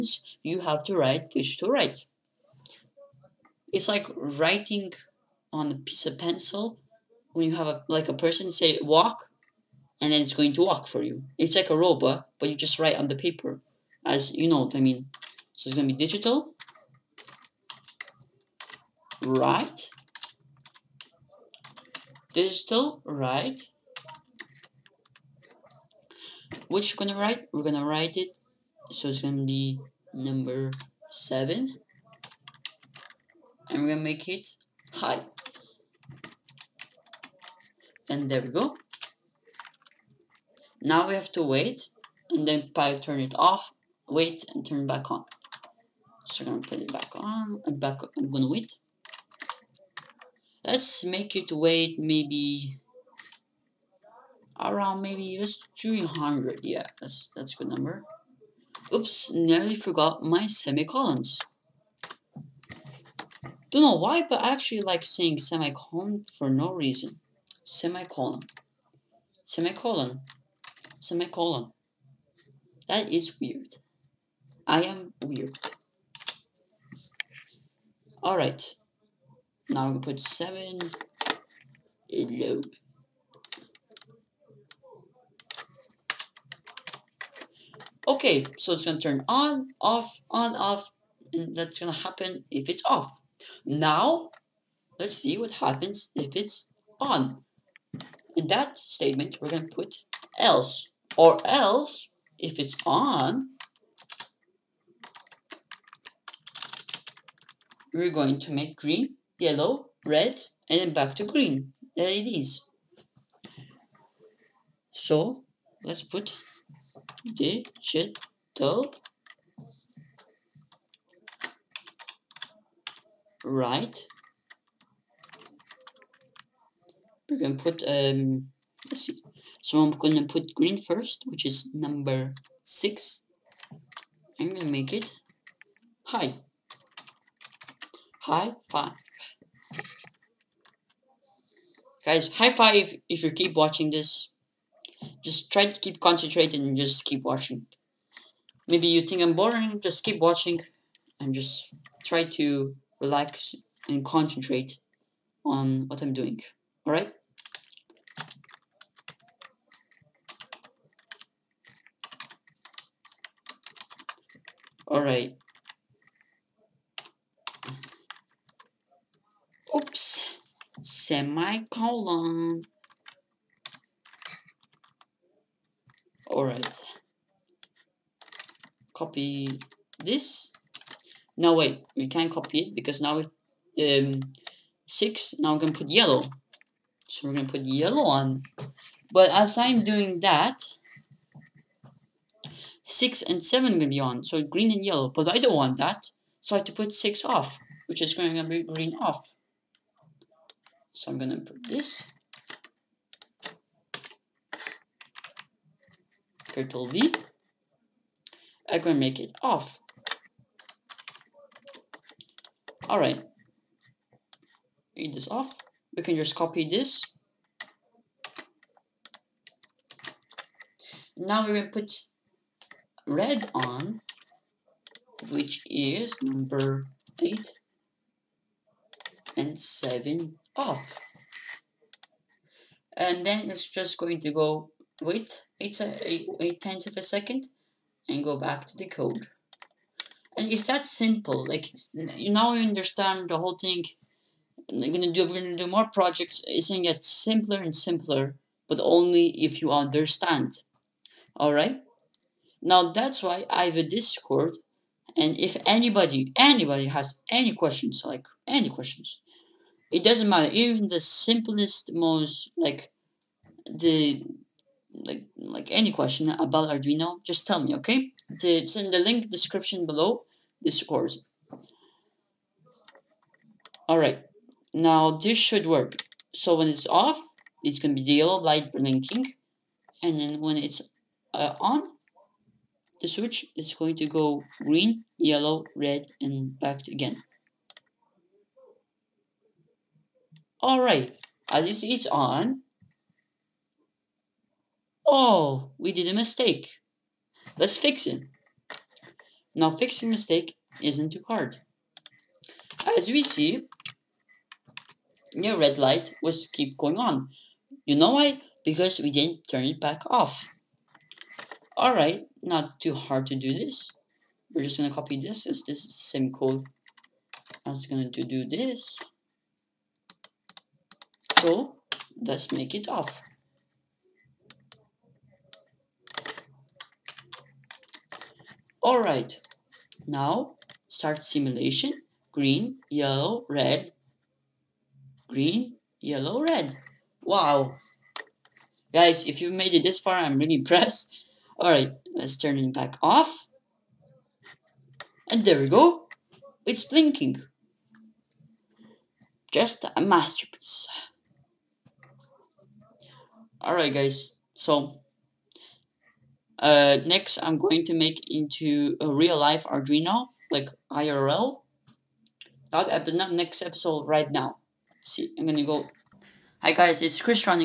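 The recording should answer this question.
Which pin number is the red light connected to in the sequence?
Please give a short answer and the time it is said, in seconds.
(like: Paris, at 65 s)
8, at 226 s.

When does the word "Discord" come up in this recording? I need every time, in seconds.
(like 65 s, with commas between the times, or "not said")
253 s, 270 s.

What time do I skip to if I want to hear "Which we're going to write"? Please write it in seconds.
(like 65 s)
26 s.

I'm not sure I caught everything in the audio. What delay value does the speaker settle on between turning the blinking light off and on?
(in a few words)
300.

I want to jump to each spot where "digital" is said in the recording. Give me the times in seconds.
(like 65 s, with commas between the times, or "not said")
16 s, 22 s, 117 s.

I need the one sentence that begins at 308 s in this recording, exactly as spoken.
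Because we didn't turn it back off.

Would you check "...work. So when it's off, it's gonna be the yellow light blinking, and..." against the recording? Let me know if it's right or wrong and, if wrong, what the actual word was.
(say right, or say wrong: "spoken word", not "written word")
right.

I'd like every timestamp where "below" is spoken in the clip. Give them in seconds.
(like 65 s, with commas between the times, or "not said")
269 s.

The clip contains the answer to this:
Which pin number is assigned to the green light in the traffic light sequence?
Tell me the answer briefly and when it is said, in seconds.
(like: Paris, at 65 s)
6, at 131 s.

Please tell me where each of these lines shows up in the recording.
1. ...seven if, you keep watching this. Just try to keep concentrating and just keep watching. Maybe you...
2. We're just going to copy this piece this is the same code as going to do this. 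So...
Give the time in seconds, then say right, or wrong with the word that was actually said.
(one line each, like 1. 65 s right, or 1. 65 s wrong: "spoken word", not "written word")
1. 142 s wrong: "five", not "seven"
2. 314 s wrong: "since", not "piece".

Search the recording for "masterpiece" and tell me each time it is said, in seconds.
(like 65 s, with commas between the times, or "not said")
349 s.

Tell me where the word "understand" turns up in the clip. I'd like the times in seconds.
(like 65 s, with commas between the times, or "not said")
242 s, 249 s.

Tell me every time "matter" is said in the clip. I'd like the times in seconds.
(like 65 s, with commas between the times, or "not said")
260 s.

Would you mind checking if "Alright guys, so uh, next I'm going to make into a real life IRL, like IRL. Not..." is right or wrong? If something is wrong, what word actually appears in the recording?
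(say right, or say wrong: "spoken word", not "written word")
wrong: "Arduino", not "IRL".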